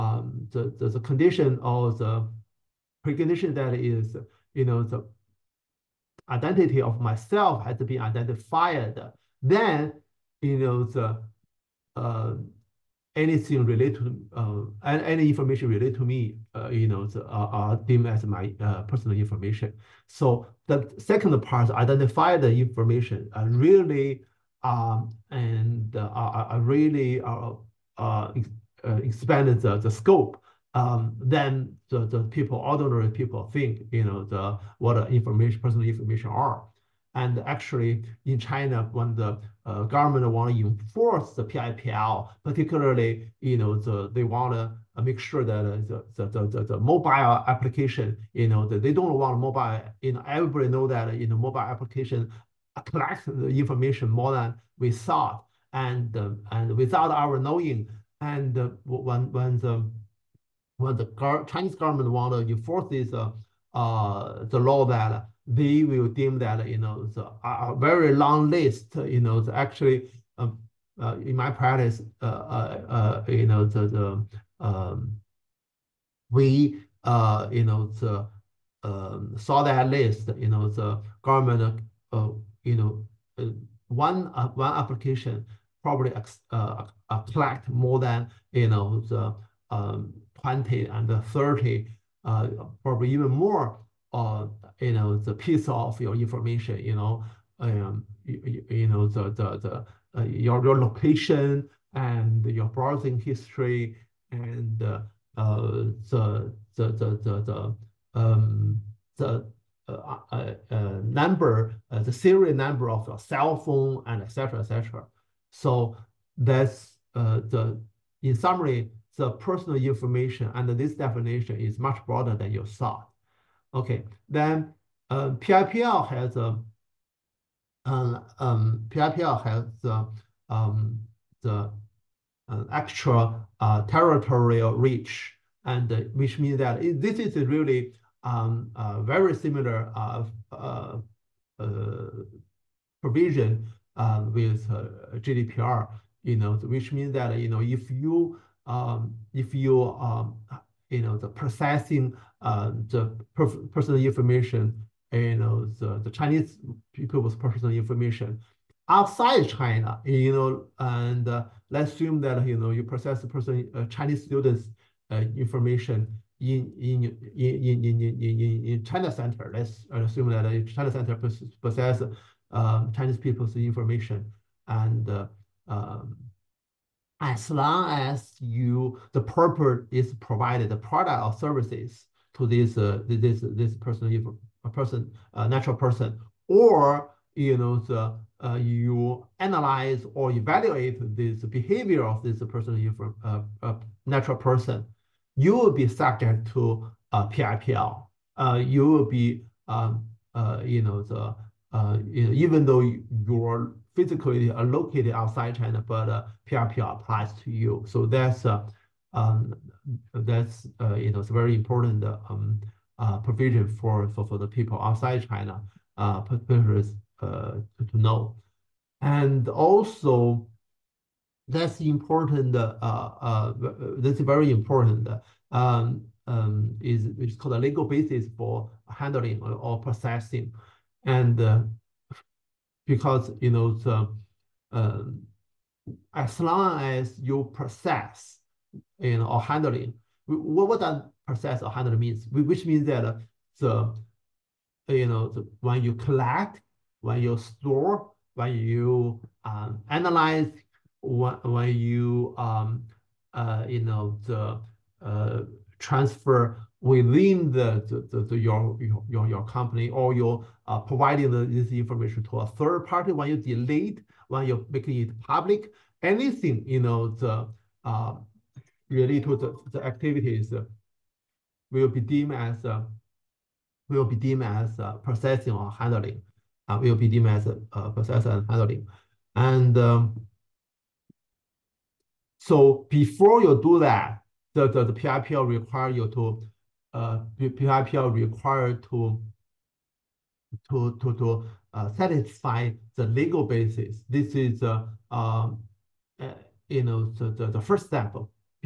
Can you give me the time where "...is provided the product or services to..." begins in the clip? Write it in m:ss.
2:59.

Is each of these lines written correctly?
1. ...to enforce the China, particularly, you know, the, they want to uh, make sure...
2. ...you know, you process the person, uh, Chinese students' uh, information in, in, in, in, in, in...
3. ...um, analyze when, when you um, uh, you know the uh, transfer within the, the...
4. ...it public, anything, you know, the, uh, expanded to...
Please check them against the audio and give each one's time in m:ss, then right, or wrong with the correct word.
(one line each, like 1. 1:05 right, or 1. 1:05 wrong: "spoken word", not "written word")
1. 0:40 wrong: "PIPL", not "China"
2. 2:42 right
3. 4:09 right
4. 4:24 wrong: "related", not "expanded".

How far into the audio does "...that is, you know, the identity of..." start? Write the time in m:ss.
0:03.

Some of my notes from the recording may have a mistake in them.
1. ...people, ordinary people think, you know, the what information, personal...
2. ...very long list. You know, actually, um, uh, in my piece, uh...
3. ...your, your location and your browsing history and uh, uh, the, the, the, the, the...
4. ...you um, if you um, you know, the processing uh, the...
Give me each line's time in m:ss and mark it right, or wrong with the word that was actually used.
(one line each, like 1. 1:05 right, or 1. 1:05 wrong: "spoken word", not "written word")
1. 0:32 right
2. 1:07 wrong: "practice", not "piece"
3. 1:40 right
4. 2:27 right.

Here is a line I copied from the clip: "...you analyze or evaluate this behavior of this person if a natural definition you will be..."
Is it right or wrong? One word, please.
wrong.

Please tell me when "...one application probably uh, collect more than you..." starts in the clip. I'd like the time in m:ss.
1:24.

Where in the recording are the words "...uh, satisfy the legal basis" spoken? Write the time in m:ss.
4:51.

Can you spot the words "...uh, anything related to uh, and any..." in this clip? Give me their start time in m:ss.
0:11.